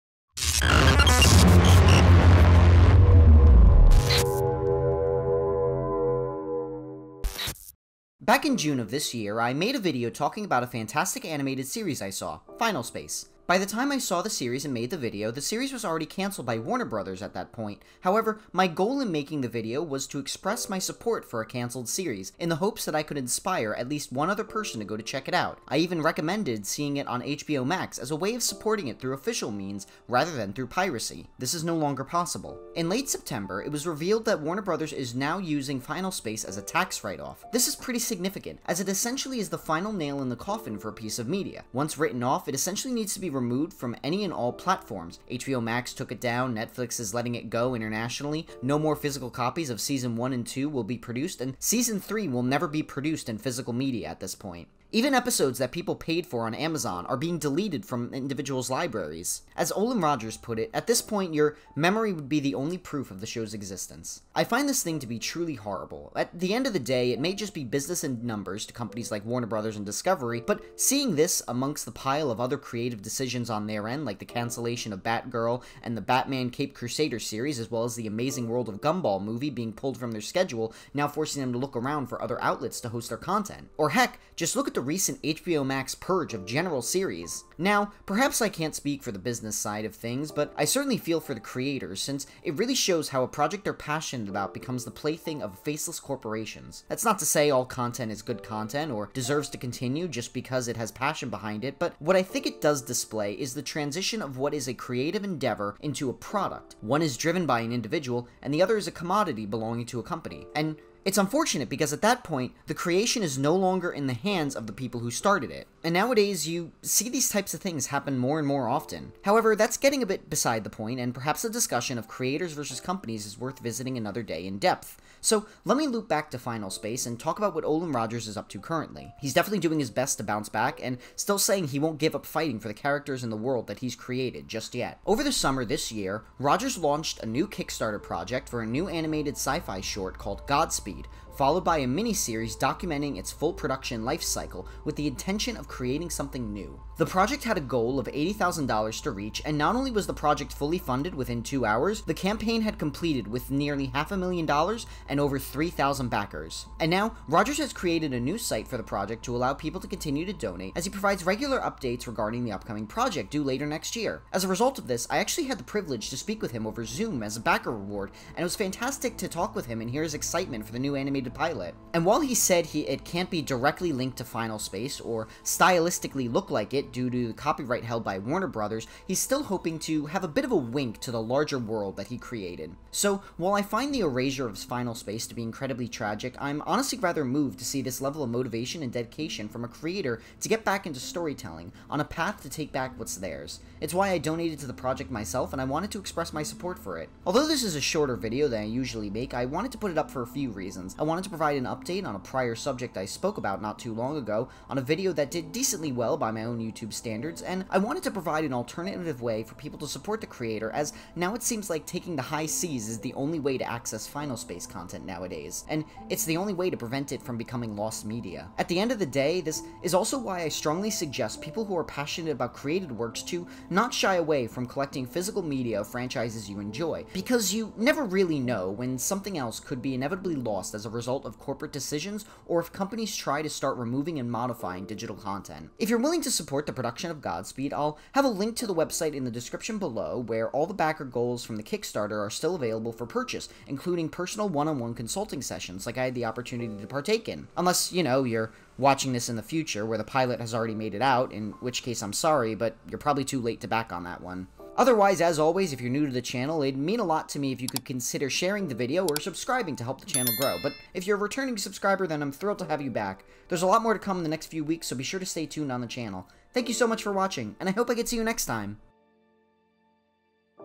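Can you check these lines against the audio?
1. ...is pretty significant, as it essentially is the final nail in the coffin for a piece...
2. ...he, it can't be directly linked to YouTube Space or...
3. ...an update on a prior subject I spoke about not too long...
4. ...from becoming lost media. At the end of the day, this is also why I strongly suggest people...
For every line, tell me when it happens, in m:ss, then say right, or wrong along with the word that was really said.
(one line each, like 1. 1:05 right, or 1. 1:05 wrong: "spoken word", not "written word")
1. 0:37 right
2. 2:52 wrong: "Final", not "YouTube"
3. 3:21 right
4. 3:37 right.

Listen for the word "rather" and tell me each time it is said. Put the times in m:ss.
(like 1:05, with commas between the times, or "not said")
0:30, 3:06.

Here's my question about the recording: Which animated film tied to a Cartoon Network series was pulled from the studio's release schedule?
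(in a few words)
The Amazing World of Gumball movie.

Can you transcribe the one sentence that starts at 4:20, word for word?
But if you're a returning subscriber, then I'm thrilled to have you back.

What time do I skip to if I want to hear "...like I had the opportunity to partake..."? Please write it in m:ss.
4:05.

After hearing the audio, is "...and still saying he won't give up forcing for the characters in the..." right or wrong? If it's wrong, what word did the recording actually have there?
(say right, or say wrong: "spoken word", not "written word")
wrong: "fighting", not "forcing".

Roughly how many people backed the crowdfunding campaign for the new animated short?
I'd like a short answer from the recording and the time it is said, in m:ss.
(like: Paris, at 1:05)
over 3,000, at 2:35.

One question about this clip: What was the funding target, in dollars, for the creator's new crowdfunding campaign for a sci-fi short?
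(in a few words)
$80,000.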